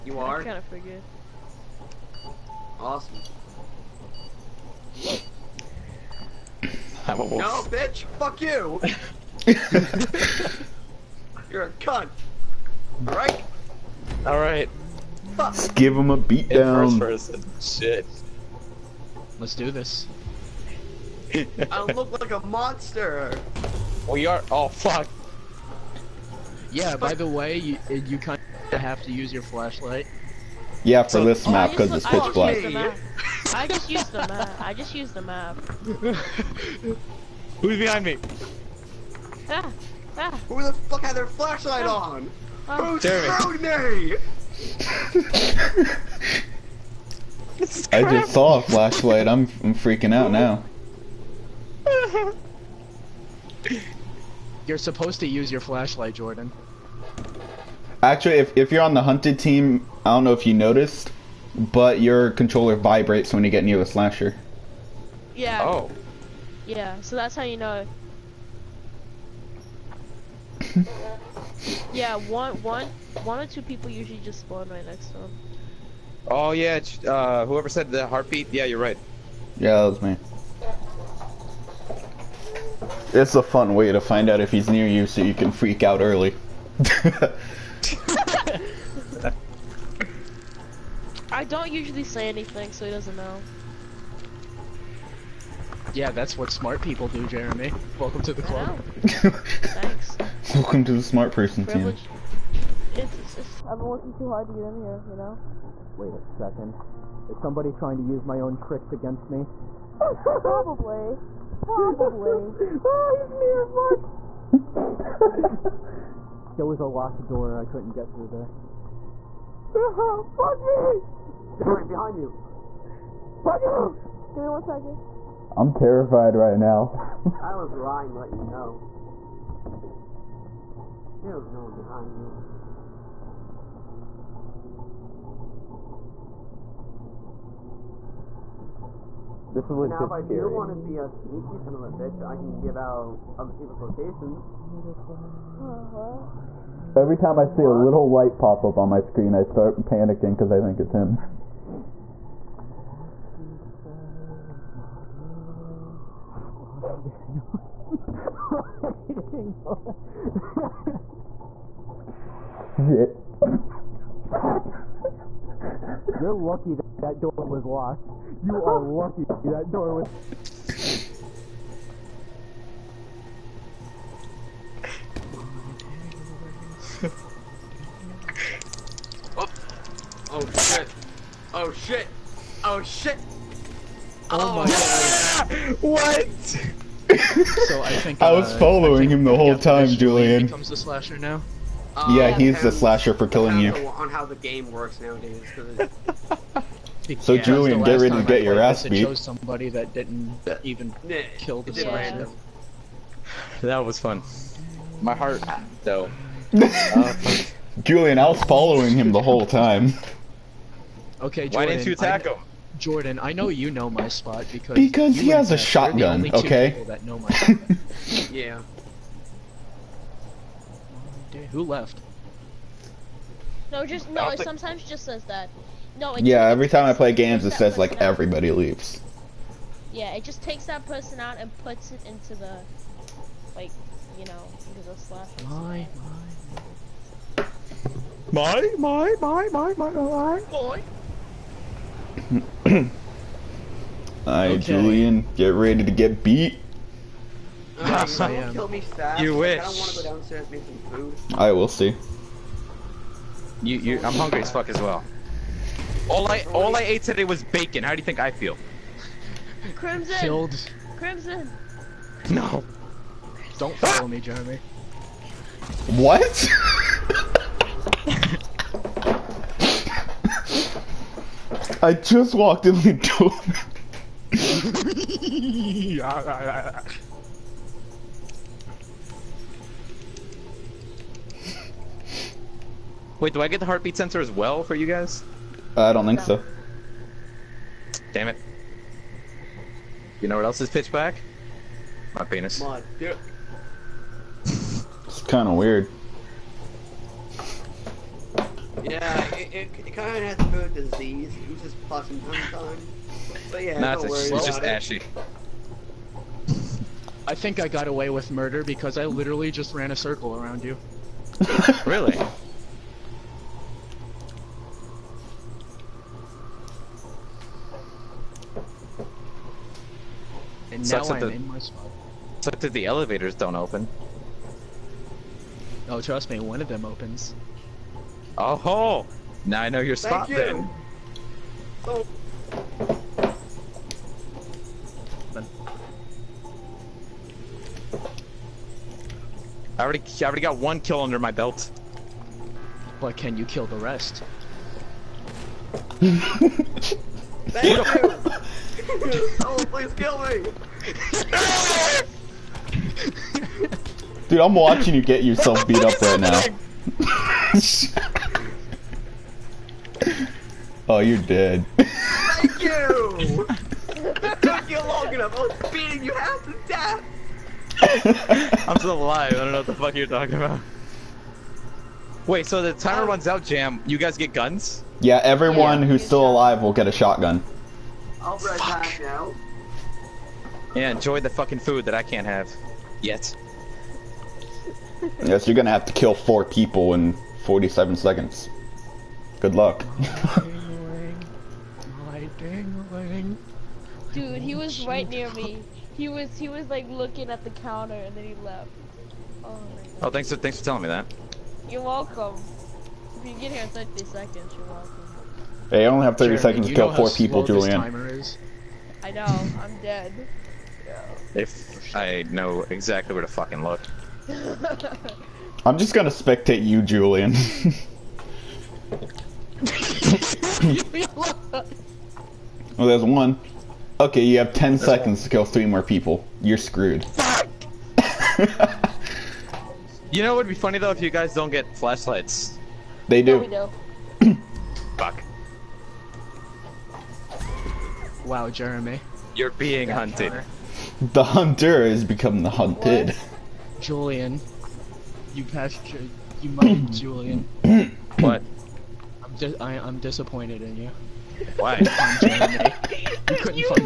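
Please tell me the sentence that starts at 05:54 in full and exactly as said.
Dude, I'm watching you get yourself beat up right now.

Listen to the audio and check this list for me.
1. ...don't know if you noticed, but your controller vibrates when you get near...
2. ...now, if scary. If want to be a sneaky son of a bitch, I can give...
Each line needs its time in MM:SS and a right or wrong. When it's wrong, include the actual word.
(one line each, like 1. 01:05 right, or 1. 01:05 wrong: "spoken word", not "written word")
1. 01:00 right
2. 02:20 right.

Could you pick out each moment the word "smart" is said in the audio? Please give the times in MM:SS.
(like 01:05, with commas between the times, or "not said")
01:36, 01:41.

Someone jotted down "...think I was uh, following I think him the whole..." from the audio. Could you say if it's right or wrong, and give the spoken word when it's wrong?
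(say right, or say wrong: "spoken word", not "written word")
right.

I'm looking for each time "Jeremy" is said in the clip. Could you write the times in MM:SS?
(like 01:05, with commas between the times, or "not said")
01:37, 04:24, 07:18.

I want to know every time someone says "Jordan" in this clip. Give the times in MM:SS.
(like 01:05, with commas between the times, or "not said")
00:56, 03:32.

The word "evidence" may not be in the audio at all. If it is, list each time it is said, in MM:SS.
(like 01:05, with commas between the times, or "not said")
not said.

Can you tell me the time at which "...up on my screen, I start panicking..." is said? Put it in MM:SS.
02:28.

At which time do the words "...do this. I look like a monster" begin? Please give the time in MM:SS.
00:19.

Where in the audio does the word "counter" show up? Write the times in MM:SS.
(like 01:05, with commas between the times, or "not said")
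06:37, 07:20.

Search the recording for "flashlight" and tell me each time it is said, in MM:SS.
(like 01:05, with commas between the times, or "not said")
00:29, 00:41, 00:48, 00:55, 07:11.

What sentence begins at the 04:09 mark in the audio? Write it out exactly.
I want to go downstairs make some food.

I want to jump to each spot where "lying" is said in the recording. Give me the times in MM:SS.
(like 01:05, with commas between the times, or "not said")
02:07.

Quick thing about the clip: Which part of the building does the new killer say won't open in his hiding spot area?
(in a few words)
The elevators.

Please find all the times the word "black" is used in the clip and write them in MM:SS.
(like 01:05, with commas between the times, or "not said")
00:32, 04:50.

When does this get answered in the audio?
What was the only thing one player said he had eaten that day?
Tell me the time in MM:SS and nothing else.
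04:17.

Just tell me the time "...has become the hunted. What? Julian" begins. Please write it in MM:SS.
07:21.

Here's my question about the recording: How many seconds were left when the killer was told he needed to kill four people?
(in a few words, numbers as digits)
47.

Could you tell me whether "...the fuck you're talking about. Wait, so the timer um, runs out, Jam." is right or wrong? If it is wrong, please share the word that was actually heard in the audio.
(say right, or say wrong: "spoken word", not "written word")
right.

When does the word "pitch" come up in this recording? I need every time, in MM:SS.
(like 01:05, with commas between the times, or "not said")
00:32, 04:50.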